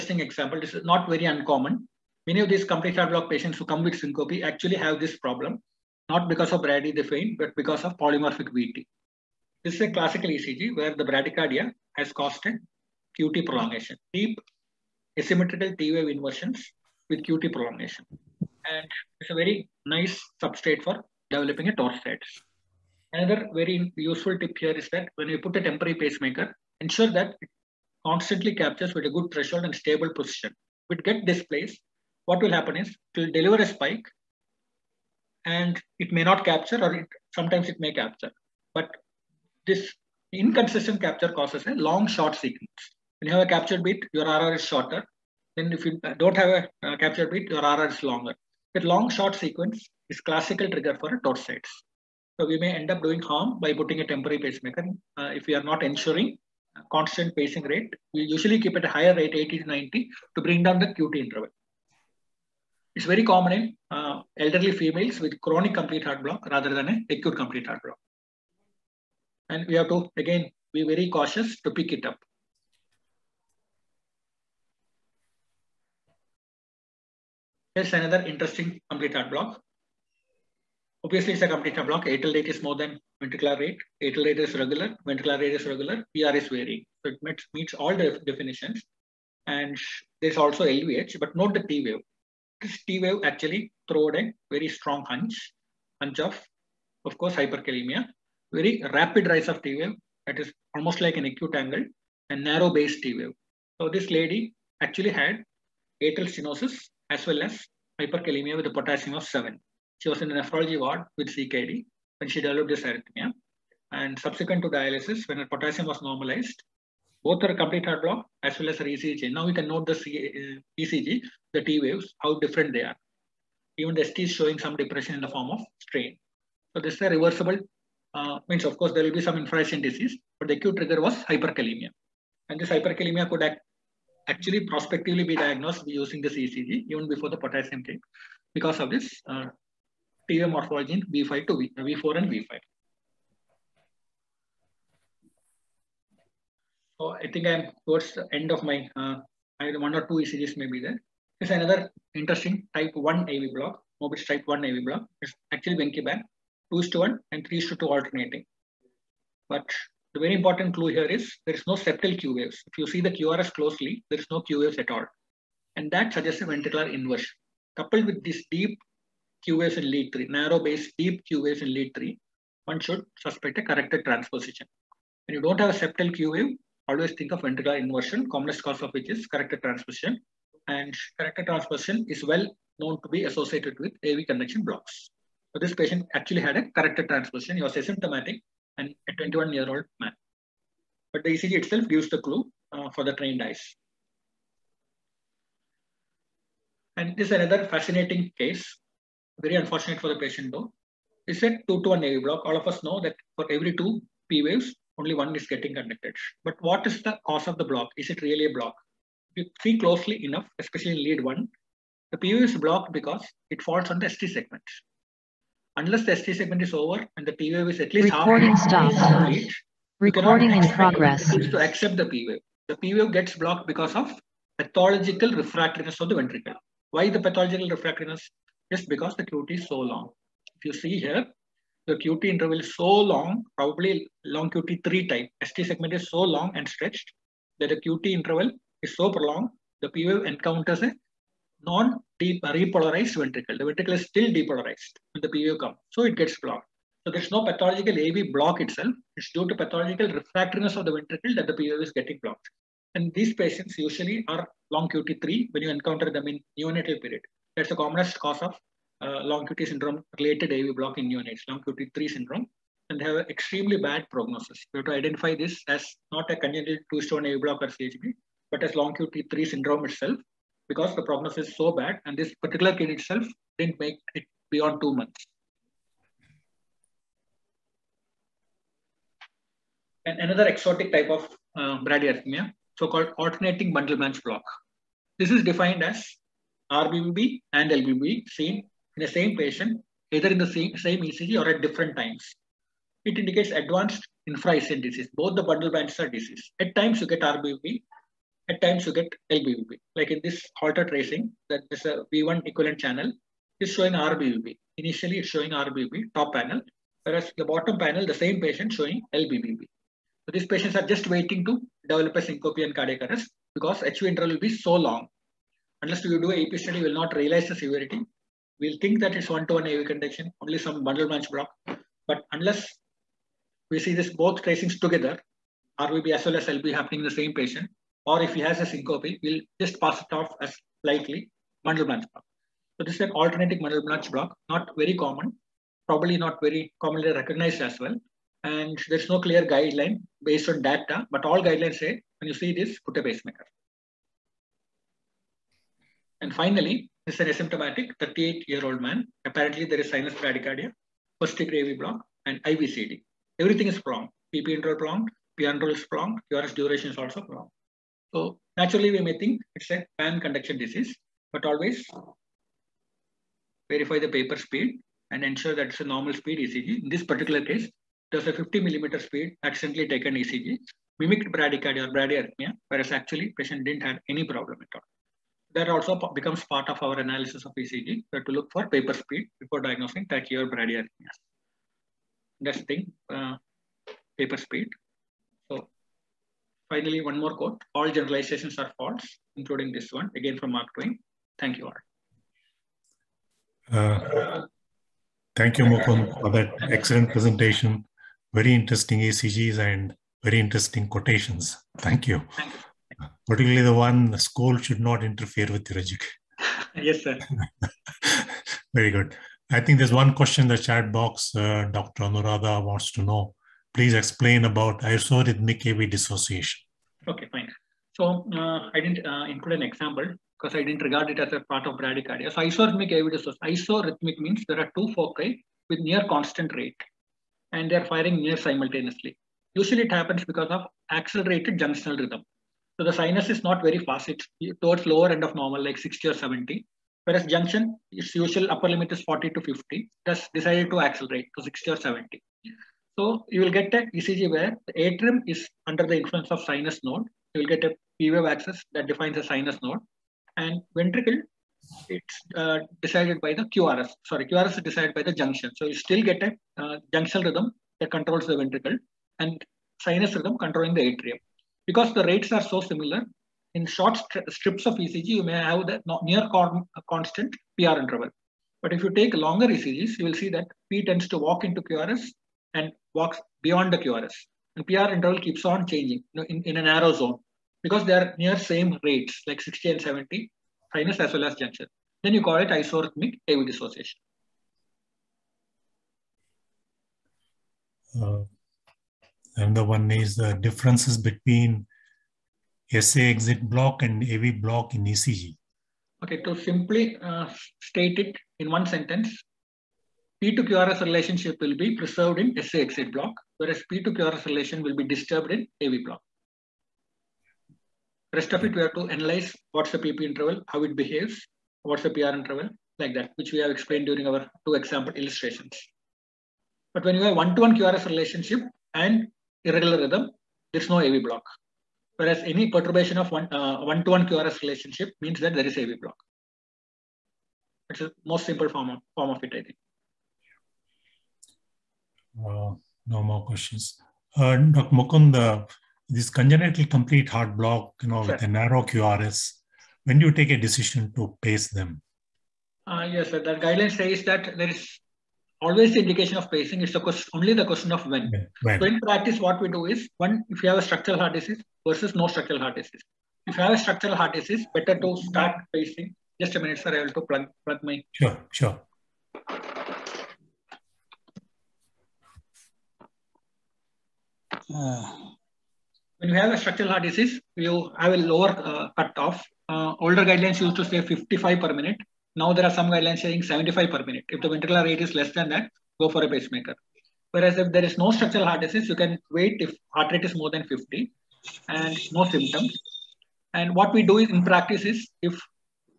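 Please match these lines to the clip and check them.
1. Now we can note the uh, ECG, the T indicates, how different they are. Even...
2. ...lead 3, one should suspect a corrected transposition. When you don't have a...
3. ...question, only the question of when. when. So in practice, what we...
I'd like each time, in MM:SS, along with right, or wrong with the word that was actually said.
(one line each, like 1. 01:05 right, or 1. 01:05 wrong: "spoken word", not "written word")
1. 01:59 wrong: "waves", not "indicates"
2. 02:51 right
3. 09:06 right.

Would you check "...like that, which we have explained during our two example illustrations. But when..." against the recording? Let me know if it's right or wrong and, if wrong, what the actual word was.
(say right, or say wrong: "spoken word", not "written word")
right.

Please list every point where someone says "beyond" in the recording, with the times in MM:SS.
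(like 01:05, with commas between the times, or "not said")
04:34, 07:53.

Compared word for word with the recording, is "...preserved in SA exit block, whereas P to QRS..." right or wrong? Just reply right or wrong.
right.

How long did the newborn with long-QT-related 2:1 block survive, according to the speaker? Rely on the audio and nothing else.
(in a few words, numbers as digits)
2 months.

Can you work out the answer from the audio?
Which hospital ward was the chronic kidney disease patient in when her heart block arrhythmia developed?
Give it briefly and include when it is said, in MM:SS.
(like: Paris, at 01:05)
Nephrology ward, at 01:50.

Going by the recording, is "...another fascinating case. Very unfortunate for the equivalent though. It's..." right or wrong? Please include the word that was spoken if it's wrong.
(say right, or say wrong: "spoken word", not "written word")
wrong: "patient", not "equivalent".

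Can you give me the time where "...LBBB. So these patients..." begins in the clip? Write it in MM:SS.
05:09.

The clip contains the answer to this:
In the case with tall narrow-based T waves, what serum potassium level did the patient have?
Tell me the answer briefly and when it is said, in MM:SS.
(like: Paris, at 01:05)
7, at 01:48.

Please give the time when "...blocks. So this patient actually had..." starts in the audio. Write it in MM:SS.
03:04.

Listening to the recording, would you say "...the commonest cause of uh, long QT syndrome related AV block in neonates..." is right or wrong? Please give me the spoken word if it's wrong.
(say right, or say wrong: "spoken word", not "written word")
right.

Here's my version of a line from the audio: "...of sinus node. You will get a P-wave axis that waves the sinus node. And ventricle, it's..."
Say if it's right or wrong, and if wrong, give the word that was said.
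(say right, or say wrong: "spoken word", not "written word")
wrong: "defines", not "waves".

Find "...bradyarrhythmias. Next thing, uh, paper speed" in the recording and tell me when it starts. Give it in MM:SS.
06:20.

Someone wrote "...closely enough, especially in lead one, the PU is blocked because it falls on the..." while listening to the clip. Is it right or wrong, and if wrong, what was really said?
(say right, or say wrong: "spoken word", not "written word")
right.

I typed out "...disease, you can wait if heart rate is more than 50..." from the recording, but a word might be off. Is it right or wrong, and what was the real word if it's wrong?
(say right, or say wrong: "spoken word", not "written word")
right.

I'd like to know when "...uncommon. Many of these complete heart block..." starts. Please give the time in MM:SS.
00:01.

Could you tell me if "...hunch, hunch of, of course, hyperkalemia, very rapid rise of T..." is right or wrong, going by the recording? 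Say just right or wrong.
right.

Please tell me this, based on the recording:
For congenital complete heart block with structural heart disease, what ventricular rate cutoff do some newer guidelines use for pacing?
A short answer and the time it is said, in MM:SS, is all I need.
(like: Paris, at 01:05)
75 per minute, at 09:33.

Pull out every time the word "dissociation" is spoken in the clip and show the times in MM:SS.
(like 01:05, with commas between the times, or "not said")
06:55, 07:03, 08:03.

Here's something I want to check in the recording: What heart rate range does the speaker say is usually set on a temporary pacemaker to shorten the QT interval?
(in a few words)
80 to 90.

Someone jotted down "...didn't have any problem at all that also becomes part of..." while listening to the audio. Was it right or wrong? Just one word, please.
right.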